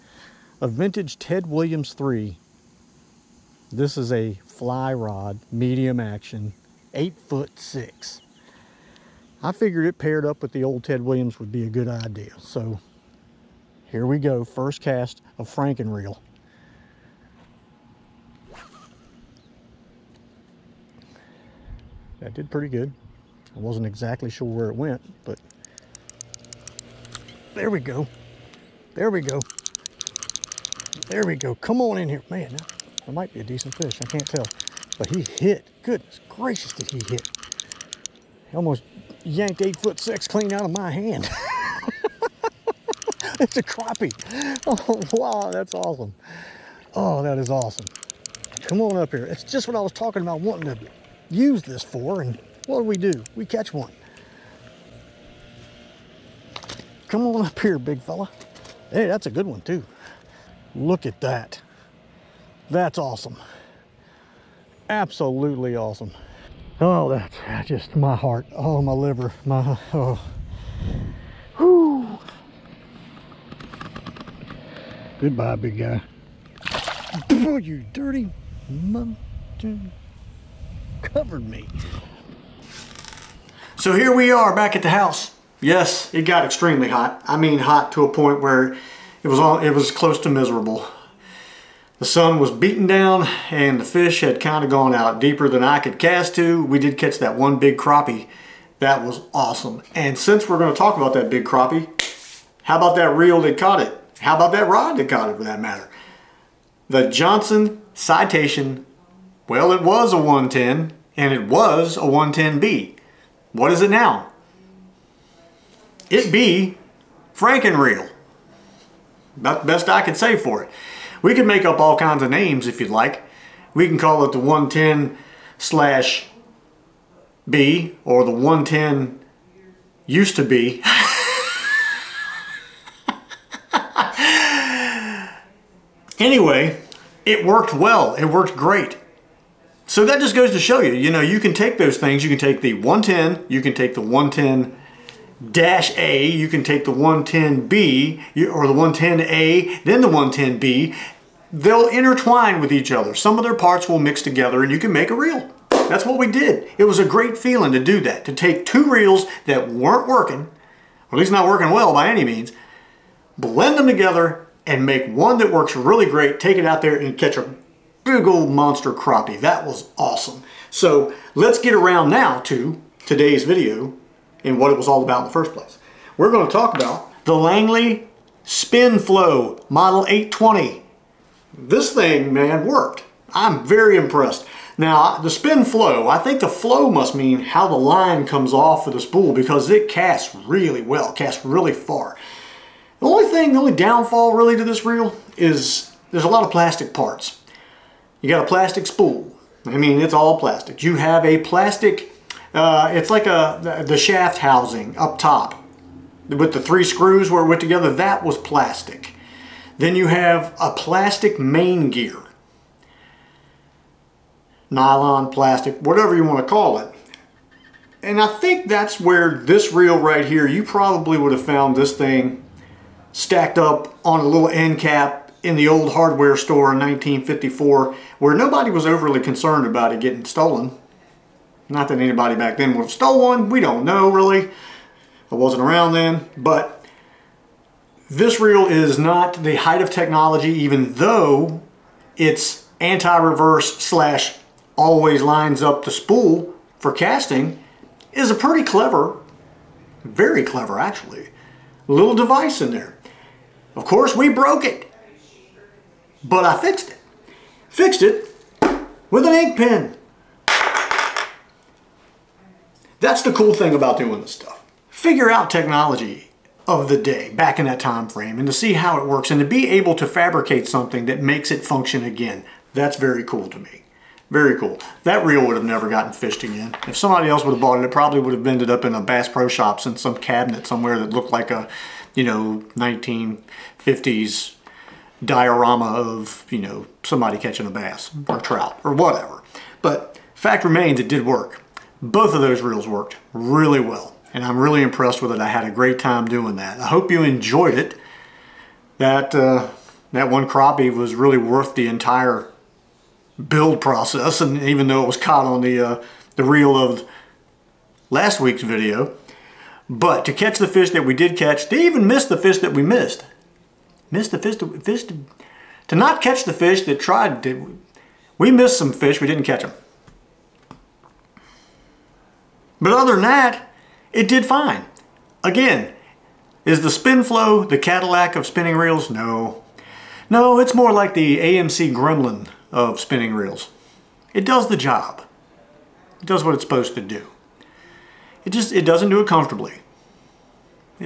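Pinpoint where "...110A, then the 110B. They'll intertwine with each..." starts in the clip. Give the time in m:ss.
2:28.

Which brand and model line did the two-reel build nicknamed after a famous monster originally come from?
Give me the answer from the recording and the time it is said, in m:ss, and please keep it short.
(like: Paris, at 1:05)
Johnson Citation, at 1:46.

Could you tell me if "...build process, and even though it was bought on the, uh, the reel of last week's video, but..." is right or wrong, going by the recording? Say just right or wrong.
wrong.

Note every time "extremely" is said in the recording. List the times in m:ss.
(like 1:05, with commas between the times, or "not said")
1:26.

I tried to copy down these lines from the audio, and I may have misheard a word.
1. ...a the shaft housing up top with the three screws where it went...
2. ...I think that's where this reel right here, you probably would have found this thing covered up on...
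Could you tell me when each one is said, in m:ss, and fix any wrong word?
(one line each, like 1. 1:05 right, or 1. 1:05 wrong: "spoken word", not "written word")
1. 3:23 right
2. 3:38 wrong: "stacked", not "covered".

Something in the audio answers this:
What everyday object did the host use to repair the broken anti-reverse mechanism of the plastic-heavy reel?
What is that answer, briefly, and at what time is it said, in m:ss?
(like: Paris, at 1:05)
An ink pen, at 4:19.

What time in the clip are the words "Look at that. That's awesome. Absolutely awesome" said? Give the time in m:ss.
1:00.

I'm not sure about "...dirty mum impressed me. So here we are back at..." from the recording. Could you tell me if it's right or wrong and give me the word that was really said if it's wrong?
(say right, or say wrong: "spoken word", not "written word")
wrong: "covered", not "impressed".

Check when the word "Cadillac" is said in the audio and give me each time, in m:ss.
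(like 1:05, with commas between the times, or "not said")
5:27.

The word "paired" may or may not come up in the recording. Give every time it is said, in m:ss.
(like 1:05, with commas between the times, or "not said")
0:09.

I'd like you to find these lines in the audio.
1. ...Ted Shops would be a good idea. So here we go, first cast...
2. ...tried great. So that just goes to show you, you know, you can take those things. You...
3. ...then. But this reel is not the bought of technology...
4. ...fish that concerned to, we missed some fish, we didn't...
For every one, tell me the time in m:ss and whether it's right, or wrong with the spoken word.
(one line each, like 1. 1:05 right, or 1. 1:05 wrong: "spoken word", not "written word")
1. 0:10 wrong: "Williams", not "Shops"
2. 2:18 wrong: "worked", not "tried"
3. 3:55 wrong: "height", not "bought"
4. 5:16 wrong: "tried", not "concerned".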